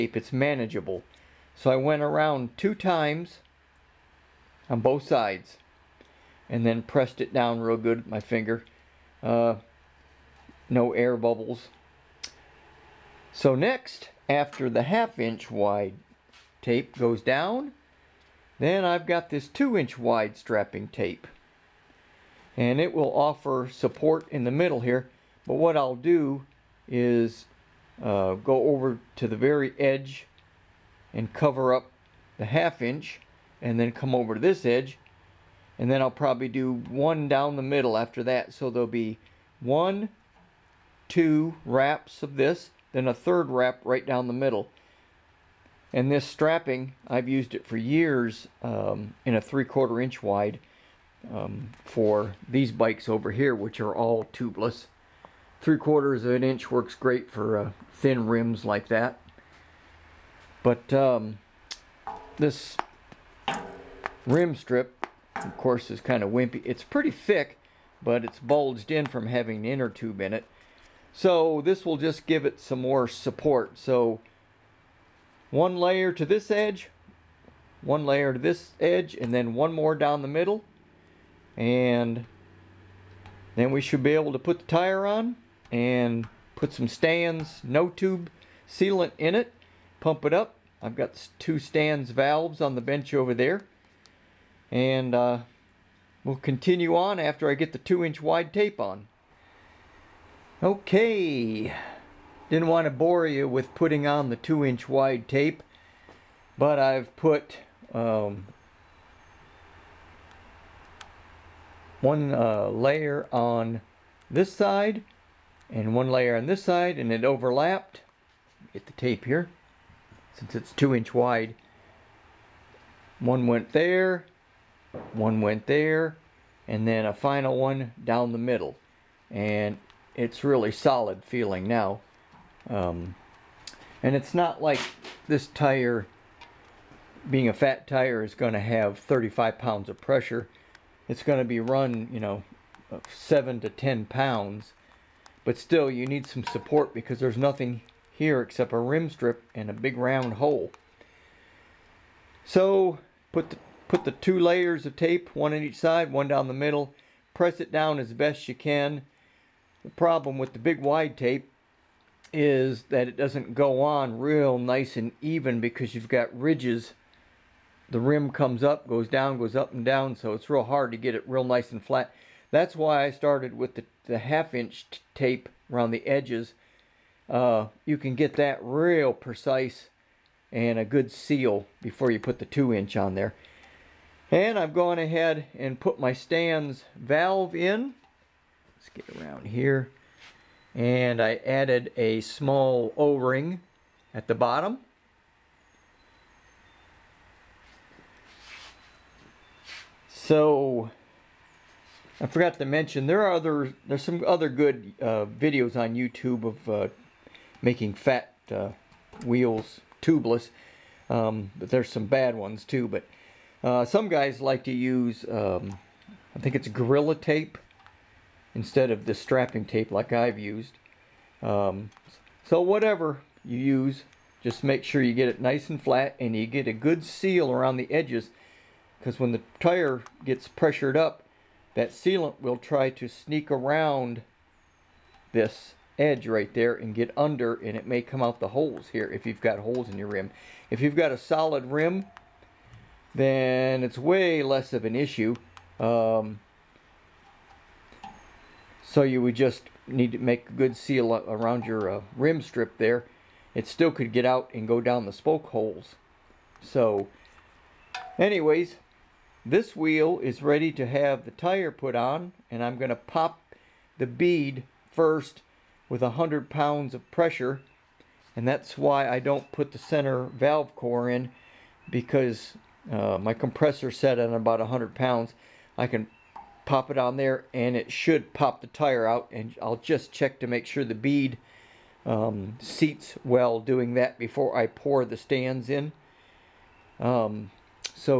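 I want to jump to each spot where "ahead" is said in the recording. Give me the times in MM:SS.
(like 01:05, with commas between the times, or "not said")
03:04.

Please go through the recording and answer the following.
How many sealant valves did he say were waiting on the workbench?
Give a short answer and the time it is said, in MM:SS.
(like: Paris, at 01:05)
2, at 01:31.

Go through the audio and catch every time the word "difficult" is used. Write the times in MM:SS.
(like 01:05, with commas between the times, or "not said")
not said.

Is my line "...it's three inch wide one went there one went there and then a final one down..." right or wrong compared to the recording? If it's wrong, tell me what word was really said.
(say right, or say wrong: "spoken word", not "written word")
wrong: "two", not "three".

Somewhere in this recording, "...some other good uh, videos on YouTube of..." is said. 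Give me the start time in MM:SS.
03:24.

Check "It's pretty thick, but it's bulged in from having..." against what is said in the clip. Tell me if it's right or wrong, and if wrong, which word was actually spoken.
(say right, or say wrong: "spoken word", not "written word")
right.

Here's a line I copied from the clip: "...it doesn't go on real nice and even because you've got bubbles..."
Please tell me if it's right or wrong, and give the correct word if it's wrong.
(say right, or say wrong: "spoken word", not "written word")
wrong: "ridges", not "bubbles".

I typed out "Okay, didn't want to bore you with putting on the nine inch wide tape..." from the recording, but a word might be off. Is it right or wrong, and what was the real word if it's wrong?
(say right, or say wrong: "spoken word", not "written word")
wrong: "two", not "nine".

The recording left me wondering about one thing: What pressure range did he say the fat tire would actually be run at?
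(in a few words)
7 to 10 pounds.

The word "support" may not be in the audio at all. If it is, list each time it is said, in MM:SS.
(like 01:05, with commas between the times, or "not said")
00:23, 01:13, 02:26.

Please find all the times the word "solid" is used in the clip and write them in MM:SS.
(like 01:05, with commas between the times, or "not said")
02:10, 04:01.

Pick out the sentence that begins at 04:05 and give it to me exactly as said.
Um, so you would just need to make a good seal around your uh, rim strip there.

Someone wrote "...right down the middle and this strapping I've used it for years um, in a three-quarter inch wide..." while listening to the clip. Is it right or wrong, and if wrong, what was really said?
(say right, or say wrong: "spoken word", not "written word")
right.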